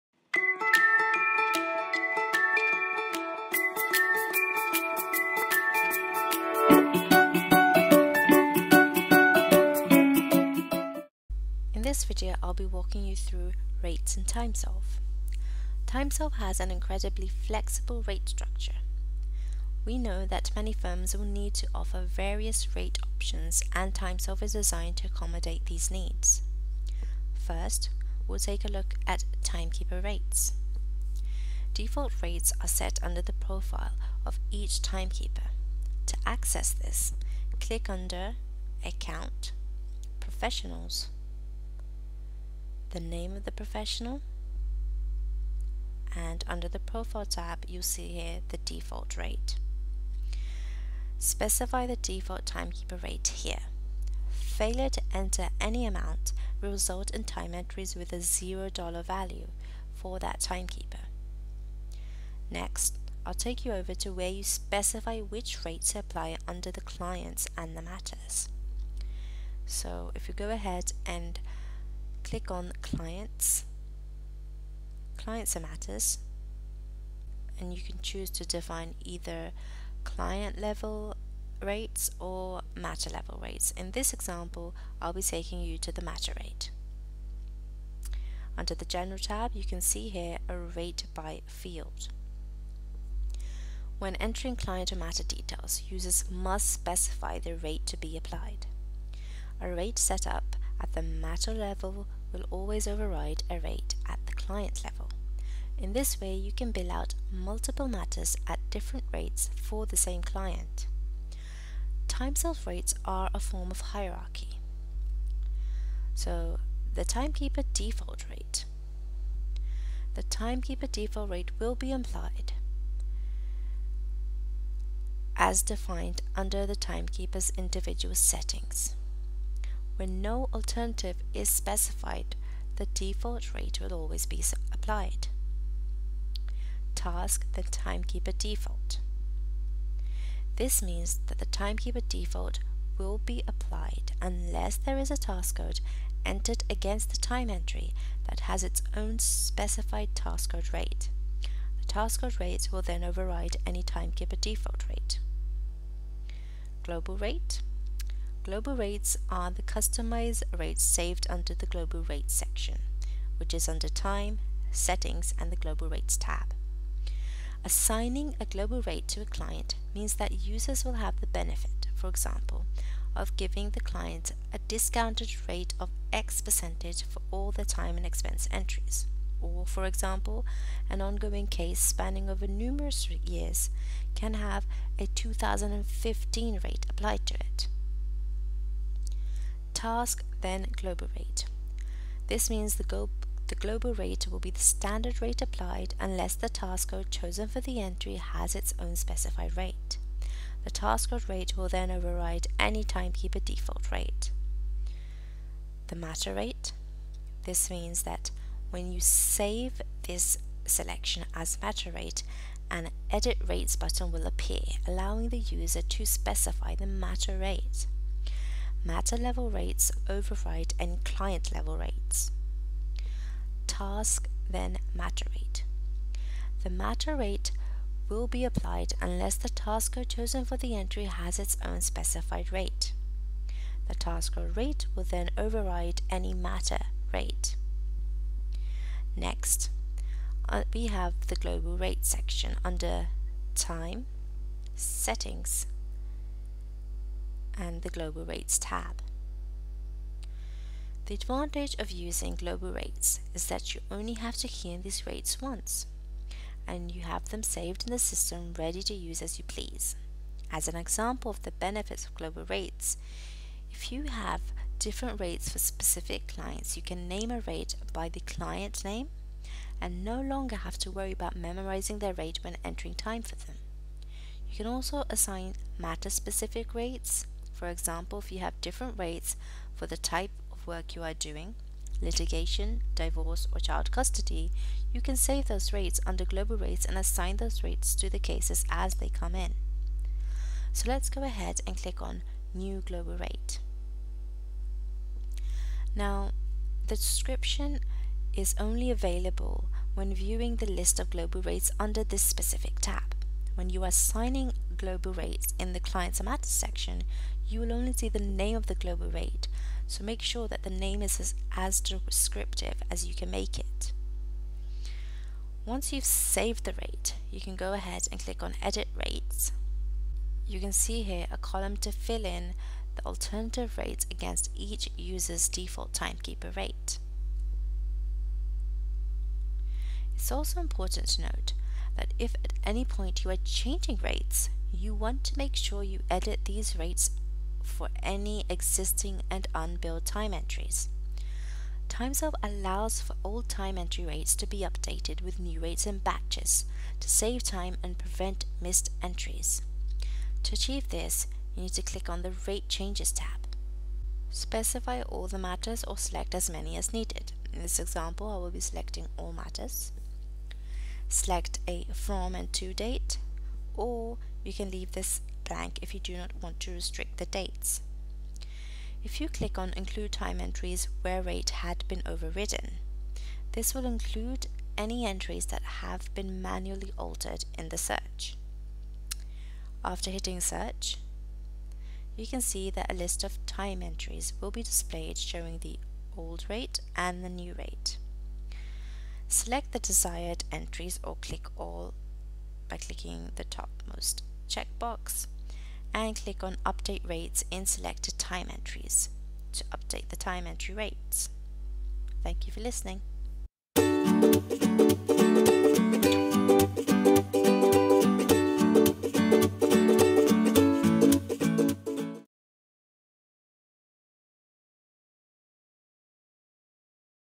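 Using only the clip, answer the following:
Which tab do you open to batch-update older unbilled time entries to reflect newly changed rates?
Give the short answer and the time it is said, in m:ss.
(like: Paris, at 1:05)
Rate Changes, at 5:52.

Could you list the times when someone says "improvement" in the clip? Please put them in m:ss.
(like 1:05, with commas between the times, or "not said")
not said.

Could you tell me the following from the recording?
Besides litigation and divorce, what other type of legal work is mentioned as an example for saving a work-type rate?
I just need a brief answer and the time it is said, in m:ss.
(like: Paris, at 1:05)
child custody, at 4:43.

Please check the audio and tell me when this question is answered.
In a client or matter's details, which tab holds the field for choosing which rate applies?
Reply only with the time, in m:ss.
1:28.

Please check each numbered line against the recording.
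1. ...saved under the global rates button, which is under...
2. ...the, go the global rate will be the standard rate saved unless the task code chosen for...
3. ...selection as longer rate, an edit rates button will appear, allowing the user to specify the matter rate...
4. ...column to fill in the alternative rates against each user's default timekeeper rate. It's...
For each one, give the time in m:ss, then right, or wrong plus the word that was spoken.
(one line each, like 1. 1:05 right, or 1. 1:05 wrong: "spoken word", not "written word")
1. 2:40 wrong: "section", not "button"
2. 3:12 wrong: "applied", not "saved"
3. 3:30 wrong: "matter", not "longer"
4. 5:21 right.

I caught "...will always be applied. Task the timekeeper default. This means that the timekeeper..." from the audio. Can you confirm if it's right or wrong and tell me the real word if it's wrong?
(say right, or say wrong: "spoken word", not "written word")
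right.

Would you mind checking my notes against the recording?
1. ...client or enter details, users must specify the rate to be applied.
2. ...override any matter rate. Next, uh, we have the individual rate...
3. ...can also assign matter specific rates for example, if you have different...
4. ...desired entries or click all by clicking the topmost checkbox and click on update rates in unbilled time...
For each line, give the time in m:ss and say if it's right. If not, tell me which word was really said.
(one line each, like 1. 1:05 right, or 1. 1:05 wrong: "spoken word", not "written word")
1. 1:34 wrong: "matter", not "enter"
2. 3:55 wrong: "global", not "individual"
3. 4:34 right
4. 6:29 wrong: "selected", not "unbilled".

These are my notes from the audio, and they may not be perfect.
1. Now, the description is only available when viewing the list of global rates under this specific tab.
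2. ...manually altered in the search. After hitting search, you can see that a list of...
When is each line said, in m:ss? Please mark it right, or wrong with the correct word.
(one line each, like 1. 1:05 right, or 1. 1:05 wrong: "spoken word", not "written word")
1. 4:55 right
2. 6:16 right.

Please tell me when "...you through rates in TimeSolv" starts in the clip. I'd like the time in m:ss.
0:13.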